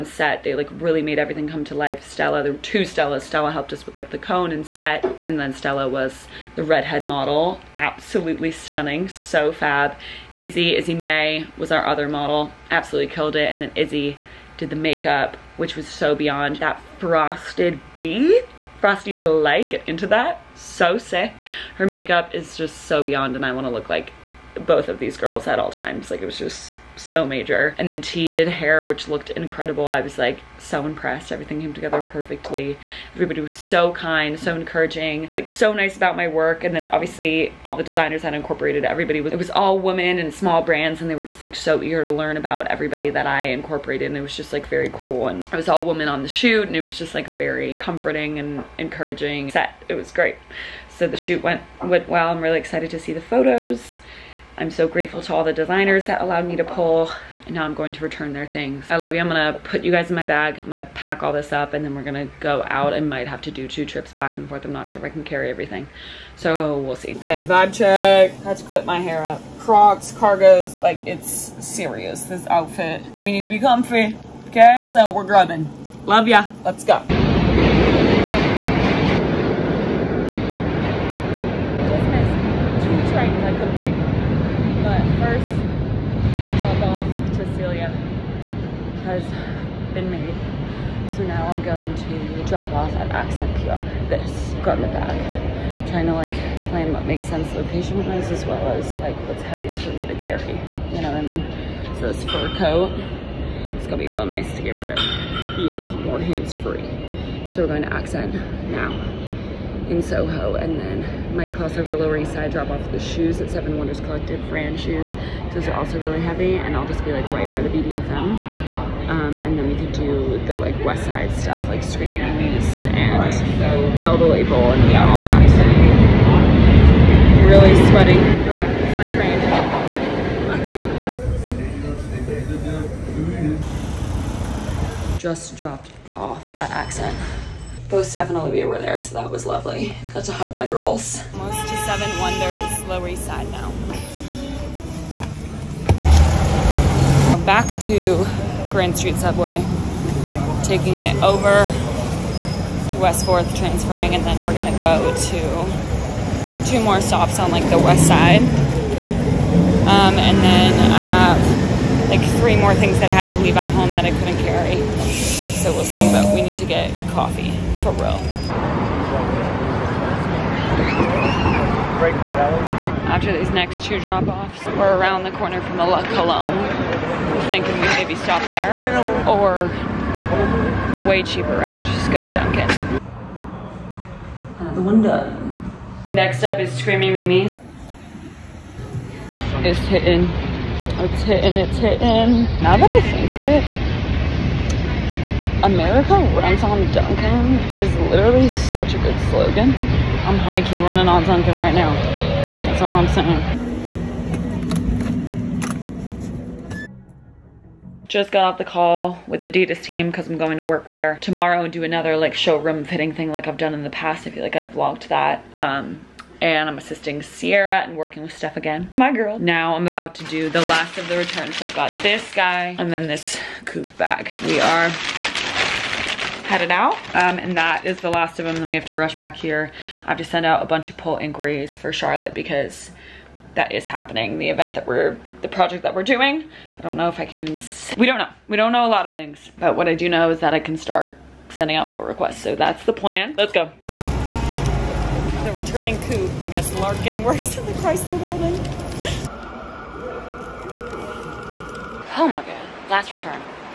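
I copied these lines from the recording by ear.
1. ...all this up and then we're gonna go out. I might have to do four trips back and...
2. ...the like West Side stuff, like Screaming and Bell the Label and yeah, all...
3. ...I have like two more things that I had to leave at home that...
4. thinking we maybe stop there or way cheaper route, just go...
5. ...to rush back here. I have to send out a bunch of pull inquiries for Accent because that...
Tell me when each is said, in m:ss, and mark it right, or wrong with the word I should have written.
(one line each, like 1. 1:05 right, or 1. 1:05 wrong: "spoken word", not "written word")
1. 1:01 wrong: "two", not "four"
2. 2:00 right
3. 2:40 wrong: "three", not "two"
4. 2:57 right
5. 3:48 wrong: "Charlotte", not "Accent".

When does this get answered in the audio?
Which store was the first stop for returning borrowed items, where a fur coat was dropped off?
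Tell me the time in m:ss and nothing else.
1:33.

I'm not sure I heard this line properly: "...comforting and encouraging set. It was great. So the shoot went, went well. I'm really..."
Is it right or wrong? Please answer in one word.
right.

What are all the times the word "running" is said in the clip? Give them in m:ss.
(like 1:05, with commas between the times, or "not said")
3:20.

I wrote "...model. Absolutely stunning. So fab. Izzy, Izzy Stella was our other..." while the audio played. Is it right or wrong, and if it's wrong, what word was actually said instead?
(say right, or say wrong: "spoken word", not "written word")
wrong: "May", not "Stella".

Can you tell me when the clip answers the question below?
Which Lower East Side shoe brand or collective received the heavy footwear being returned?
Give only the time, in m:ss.
1:53.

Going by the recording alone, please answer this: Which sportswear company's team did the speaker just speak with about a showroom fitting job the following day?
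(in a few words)
Adidas.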